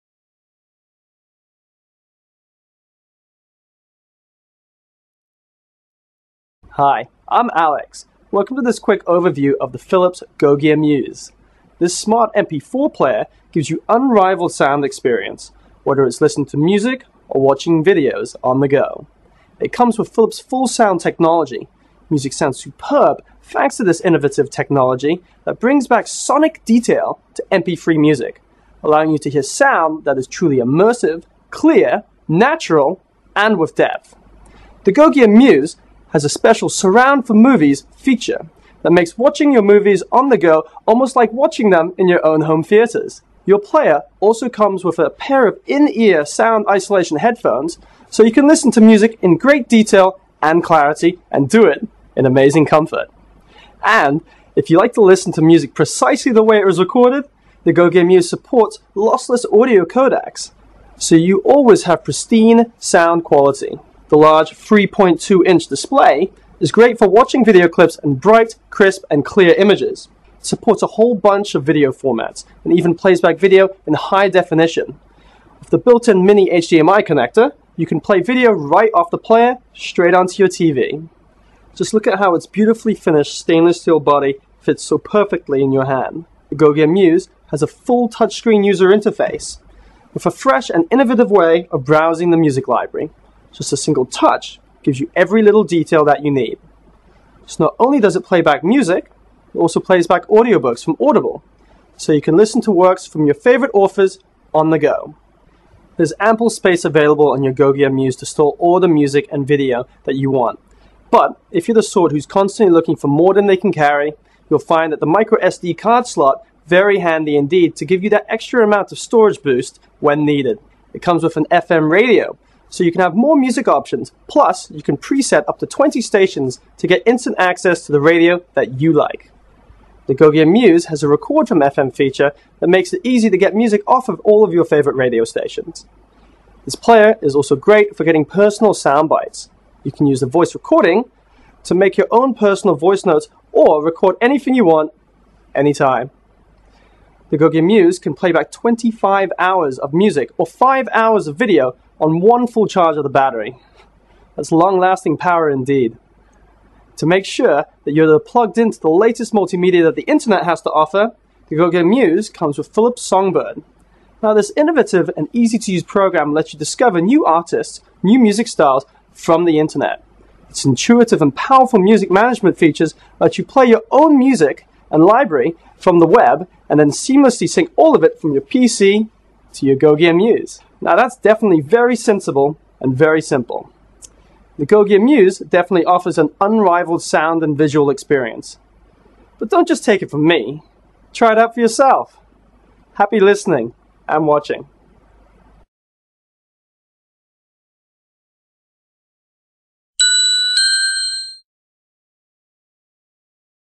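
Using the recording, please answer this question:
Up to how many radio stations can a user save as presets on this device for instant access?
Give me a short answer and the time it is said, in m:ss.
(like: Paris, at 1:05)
20, at 2:05.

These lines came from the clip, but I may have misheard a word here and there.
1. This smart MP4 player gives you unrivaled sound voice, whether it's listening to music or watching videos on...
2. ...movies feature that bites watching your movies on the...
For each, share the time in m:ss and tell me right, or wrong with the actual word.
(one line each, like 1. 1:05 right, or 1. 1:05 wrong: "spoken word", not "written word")
1. 0:11 wrong: "experience", not "voice"
2. 0:37 wrong: "makes", not "bites".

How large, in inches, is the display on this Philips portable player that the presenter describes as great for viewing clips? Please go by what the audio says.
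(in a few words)
3.2 inch.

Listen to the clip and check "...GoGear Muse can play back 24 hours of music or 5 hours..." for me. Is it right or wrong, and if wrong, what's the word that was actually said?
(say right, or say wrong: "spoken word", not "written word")
wrong: "25", not "24".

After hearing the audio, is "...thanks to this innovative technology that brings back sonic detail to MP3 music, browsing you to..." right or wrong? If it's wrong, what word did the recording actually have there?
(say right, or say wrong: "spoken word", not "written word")
wrong: "allowing", not "browsing".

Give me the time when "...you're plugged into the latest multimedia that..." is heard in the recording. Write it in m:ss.
2:37.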